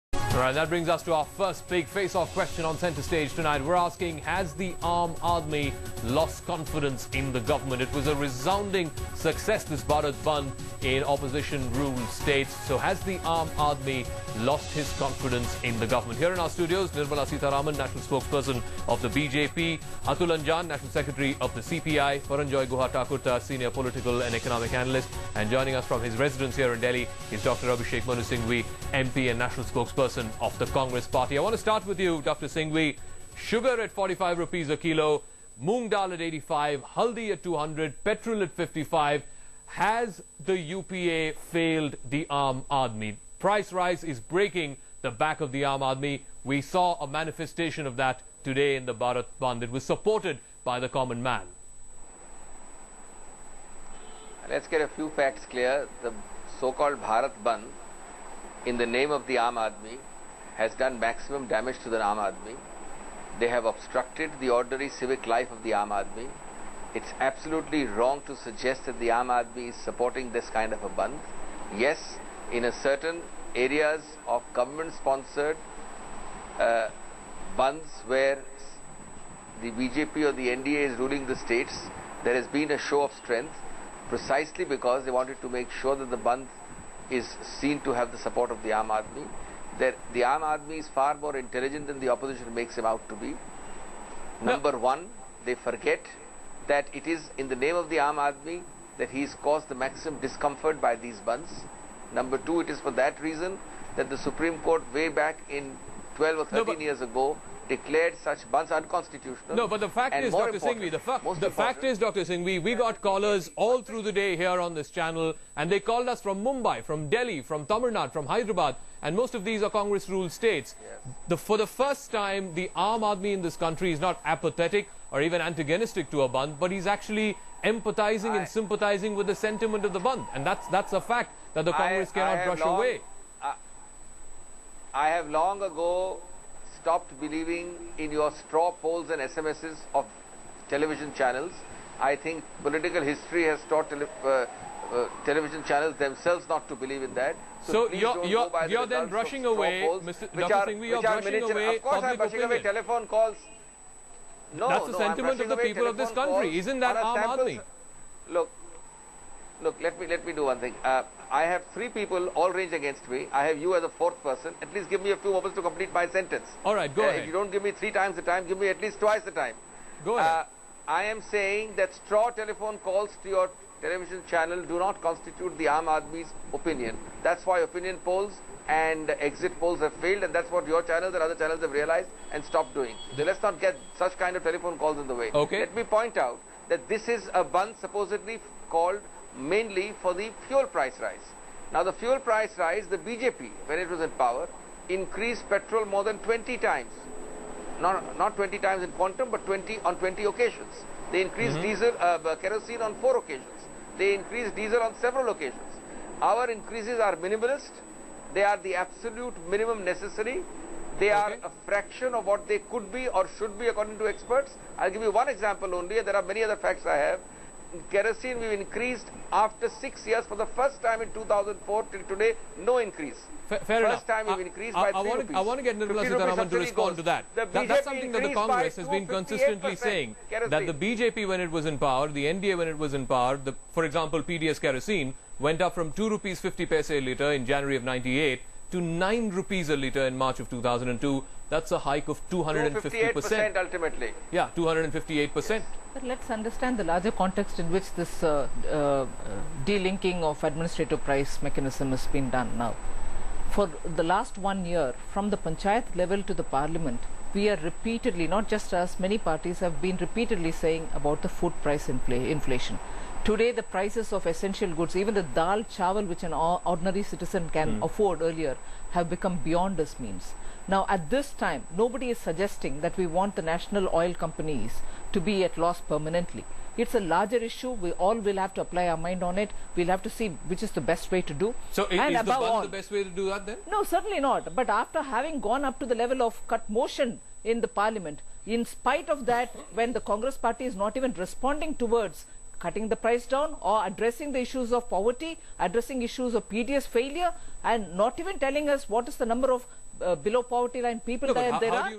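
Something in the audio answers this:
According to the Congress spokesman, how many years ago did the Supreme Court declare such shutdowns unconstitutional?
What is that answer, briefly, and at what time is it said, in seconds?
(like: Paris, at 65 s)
12 or 13, at 106 s.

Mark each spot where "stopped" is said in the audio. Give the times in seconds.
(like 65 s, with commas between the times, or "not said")
136 s, 182 s.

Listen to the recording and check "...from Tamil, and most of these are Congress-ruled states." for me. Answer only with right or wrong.
wrong.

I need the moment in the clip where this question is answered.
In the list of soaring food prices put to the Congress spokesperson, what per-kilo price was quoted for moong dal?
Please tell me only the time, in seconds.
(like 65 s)
35 s.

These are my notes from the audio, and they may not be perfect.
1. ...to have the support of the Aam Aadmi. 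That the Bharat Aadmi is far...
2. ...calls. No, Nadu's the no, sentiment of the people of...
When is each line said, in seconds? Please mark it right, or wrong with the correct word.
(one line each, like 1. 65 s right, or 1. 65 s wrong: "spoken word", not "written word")
1. 87 s wrong: "Aam", not "Bharat"
2. 153 s wrong: "That", not "Nadu".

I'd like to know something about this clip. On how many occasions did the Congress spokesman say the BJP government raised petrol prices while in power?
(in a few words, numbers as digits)
20.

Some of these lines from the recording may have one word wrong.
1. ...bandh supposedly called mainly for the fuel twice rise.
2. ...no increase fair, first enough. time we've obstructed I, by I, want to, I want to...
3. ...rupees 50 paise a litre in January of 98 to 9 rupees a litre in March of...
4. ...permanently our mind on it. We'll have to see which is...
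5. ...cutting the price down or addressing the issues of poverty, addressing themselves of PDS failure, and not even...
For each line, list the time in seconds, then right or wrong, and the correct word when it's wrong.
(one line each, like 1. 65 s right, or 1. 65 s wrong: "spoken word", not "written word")
1. 187 s wrong: "price", not "twice"
2. 222 s wrong: "increased", not "obstructed"
3. 236 s right
4. 278 s wrong: "apply", not "permanently"
5. 292 s wrong: "issues", not "themselves".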